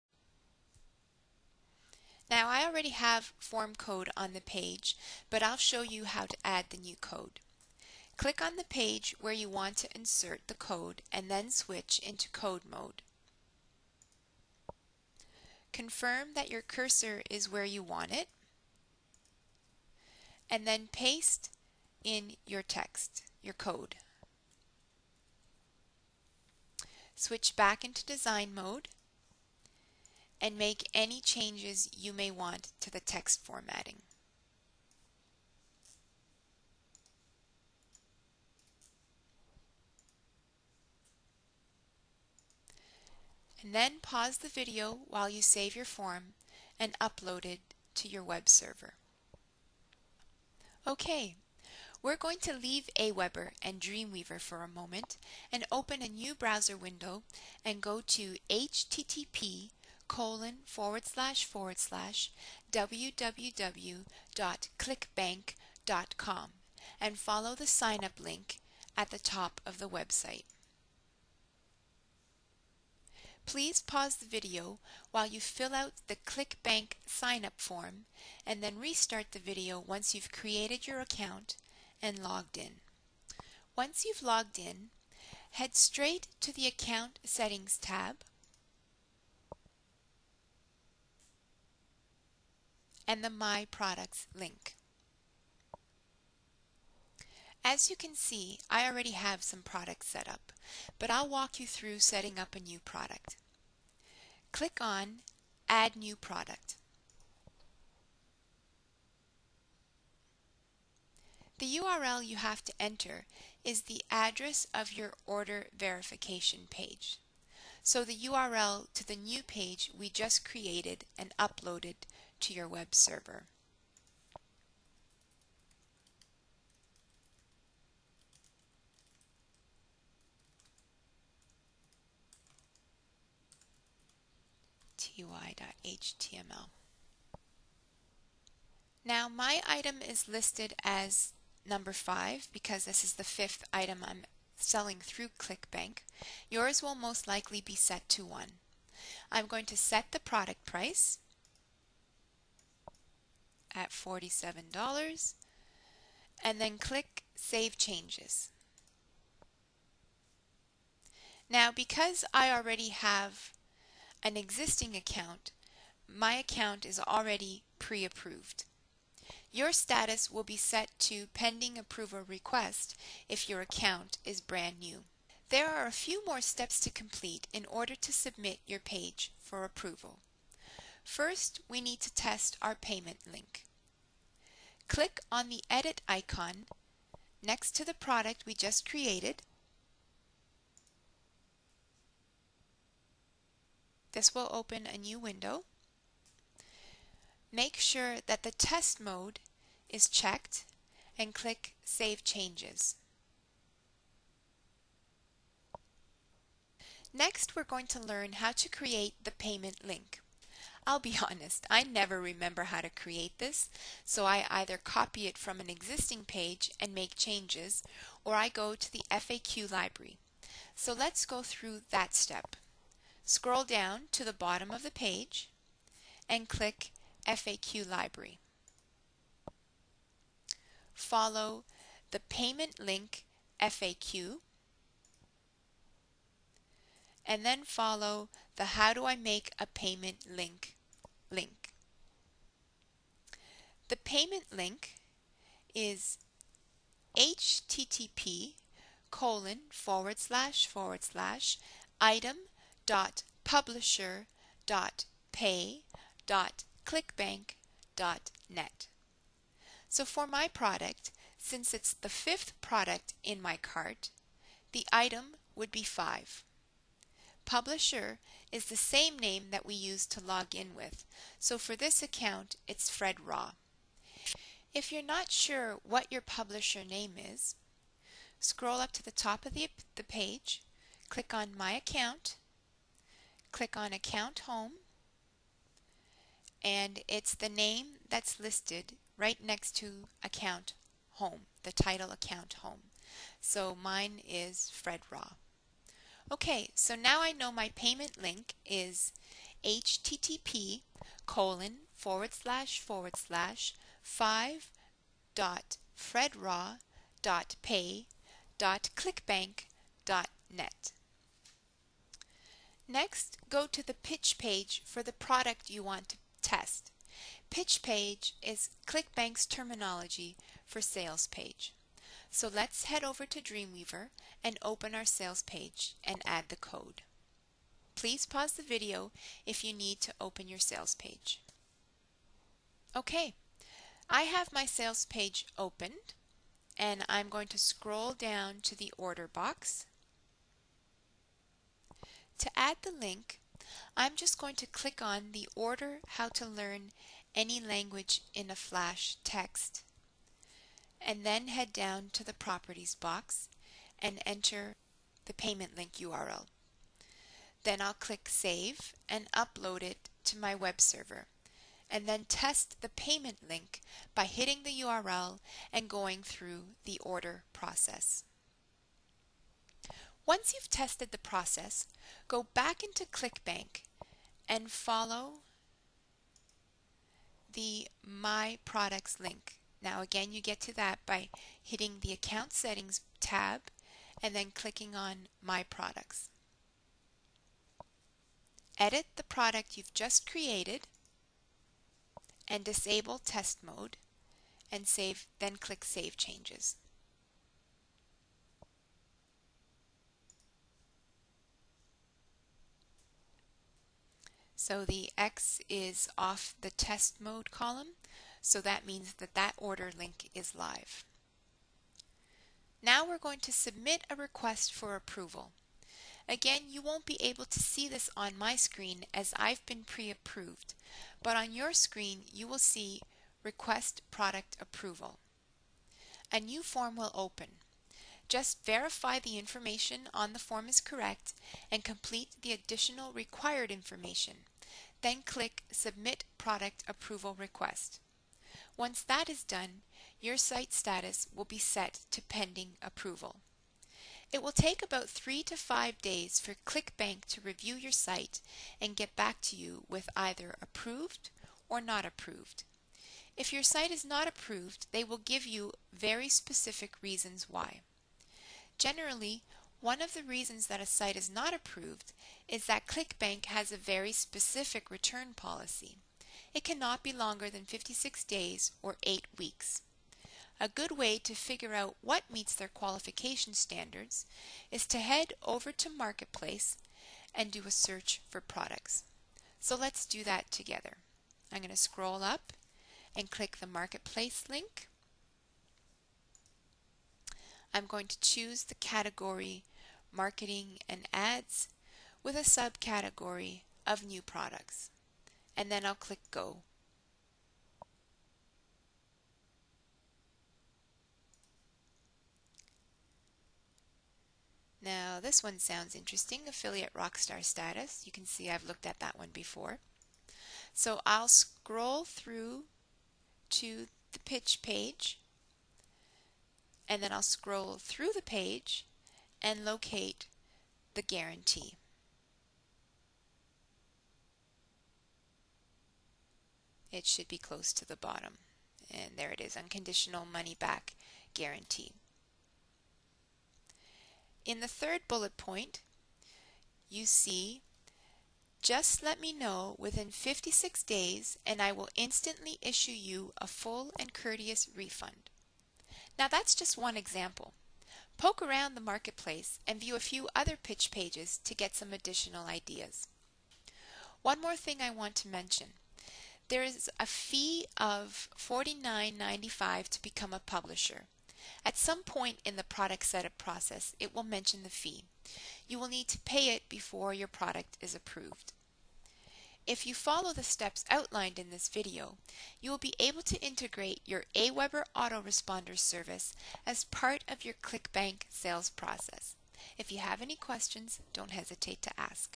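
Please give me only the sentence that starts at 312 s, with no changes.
Next, go to the pitch page for the product you want to test.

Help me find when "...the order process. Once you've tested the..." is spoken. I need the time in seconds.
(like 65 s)
366 s.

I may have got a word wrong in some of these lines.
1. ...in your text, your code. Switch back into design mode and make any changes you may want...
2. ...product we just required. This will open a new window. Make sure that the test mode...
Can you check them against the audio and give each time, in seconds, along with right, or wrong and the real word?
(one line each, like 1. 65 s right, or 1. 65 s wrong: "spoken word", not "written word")
1. 22 s right
2. 187 s wrong: "created", not "required".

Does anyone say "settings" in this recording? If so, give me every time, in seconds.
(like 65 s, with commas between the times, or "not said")
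87 s, 101 s, 382 s.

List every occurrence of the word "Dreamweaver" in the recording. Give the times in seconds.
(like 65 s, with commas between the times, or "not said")
53 s, 323 s.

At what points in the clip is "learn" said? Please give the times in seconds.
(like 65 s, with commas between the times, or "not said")
208 s, 346 s.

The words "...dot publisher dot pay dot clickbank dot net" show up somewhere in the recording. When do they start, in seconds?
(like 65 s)
252 s.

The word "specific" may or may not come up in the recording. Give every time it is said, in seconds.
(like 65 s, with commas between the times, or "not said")
456 s, 464 s.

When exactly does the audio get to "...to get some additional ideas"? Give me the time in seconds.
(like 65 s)
551 s.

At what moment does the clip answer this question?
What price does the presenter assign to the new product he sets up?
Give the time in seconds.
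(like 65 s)
153 s.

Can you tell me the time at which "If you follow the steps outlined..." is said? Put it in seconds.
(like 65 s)
569 s.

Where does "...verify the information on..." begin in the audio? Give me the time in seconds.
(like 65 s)
428 s.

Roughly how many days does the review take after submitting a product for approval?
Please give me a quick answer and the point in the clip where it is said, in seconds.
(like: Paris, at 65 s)
3 to 5 days, at 445 s.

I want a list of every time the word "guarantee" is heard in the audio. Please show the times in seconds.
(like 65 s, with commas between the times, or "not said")
521 s, 531 s.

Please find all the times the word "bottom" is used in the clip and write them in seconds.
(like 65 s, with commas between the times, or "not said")
224 s, 527 s.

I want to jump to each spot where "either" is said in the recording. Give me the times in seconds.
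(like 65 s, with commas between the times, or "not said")
214 s, 450 s.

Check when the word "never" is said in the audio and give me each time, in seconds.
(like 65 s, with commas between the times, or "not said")
211 s.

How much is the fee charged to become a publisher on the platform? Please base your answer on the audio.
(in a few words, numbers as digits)
$49.95.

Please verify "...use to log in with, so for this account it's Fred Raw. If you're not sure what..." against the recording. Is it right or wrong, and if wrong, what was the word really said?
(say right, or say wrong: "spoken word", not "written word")
right.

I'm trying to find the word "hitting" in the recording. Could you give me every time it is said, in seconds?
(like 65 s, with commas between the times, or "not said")
364 s, 381 s.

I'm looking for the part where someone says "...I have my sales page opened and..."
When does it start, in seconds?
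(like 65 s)
334 s.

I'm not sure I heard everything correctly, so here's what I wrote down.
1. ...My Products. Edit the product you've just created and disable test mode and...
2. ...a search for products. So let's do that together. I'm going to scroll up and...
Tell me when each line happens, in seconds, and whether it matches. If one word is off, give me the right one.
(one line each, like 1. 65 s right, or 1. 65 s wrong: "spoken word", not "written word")
1. 385 s right
2. 477 s right.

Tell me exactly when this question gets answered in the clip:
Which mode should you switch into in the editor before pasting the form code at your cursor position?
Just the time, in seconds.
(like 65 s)
12 s.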